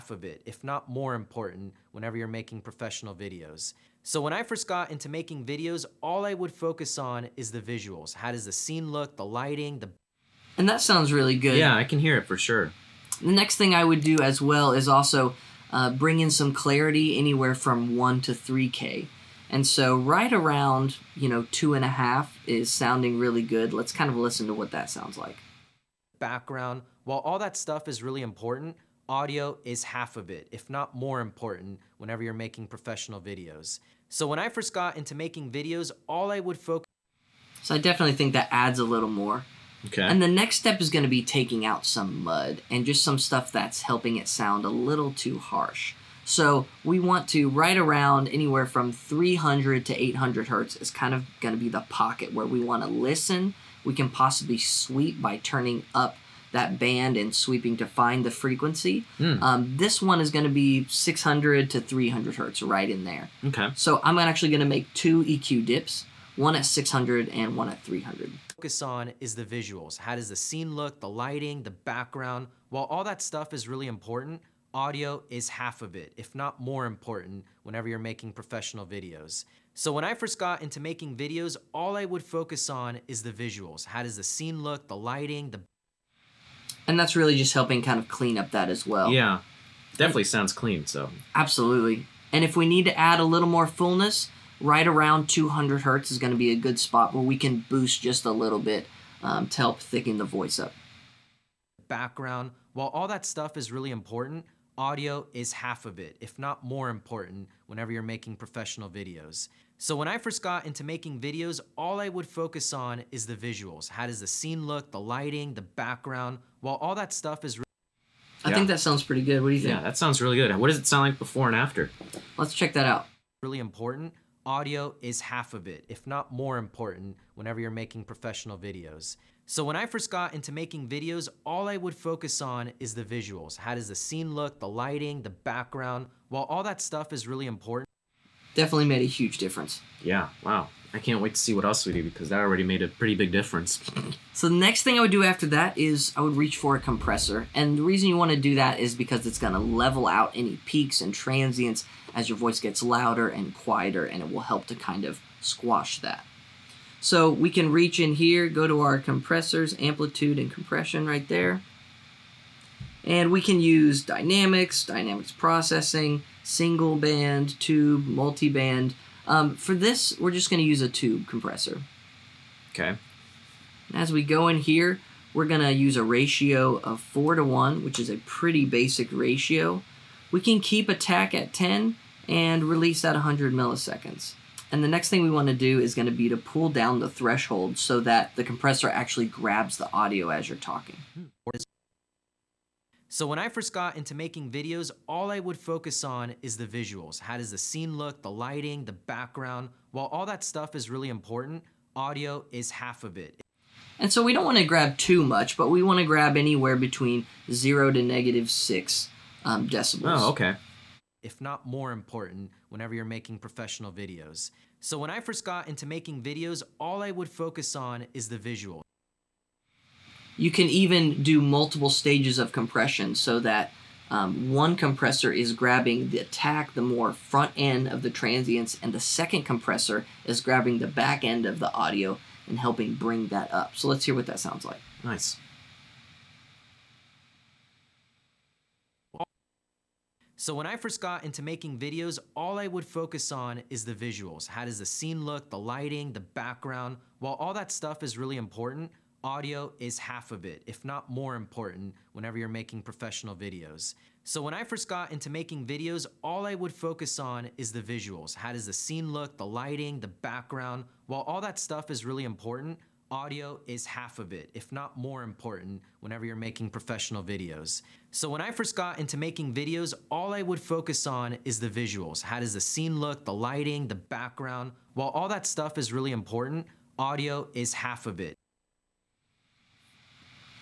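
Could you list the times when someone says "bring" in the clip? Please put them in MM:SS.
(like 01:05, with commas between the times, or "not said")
00:15, 03:52.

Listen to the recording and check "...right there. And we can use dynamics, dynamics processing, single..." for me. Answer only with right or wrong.
right.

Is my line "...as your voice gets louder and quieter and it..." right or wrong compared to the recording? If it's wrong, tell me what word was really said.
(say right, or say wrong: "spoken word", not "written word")
right.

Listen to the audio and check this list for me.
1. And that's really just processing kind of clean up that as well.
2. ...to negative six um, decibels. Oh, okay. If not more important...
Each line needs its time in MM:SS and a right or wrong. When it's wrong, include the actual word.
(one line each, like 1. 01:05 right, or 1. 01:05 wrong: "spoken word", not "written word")
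1. 01:26 wrong: "helping", not "processing"
2. 03:27 right.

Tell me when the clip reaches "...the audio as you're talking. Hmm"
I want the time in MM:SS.
03:09.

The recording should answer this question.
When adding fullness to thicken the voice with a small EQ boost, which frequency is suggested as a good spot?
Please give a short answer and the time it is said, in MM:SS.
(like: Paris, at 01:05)
200 hertz, at 01:35.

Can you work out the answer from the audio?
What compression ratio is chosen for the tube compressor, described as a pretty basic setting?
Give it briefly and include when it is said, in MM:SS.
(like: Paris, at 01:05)
4 to 1, at 02:57.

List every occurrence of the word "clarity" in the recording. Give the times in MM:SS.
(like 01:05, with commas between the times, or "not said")
00:16.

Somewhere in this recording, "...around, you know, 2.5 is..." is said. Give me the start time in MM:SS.
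00:20.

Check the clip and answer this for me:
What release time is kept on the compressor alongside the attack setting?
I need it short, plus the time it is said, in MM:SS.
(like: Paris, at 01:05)
100 milliseconds, at 03:03.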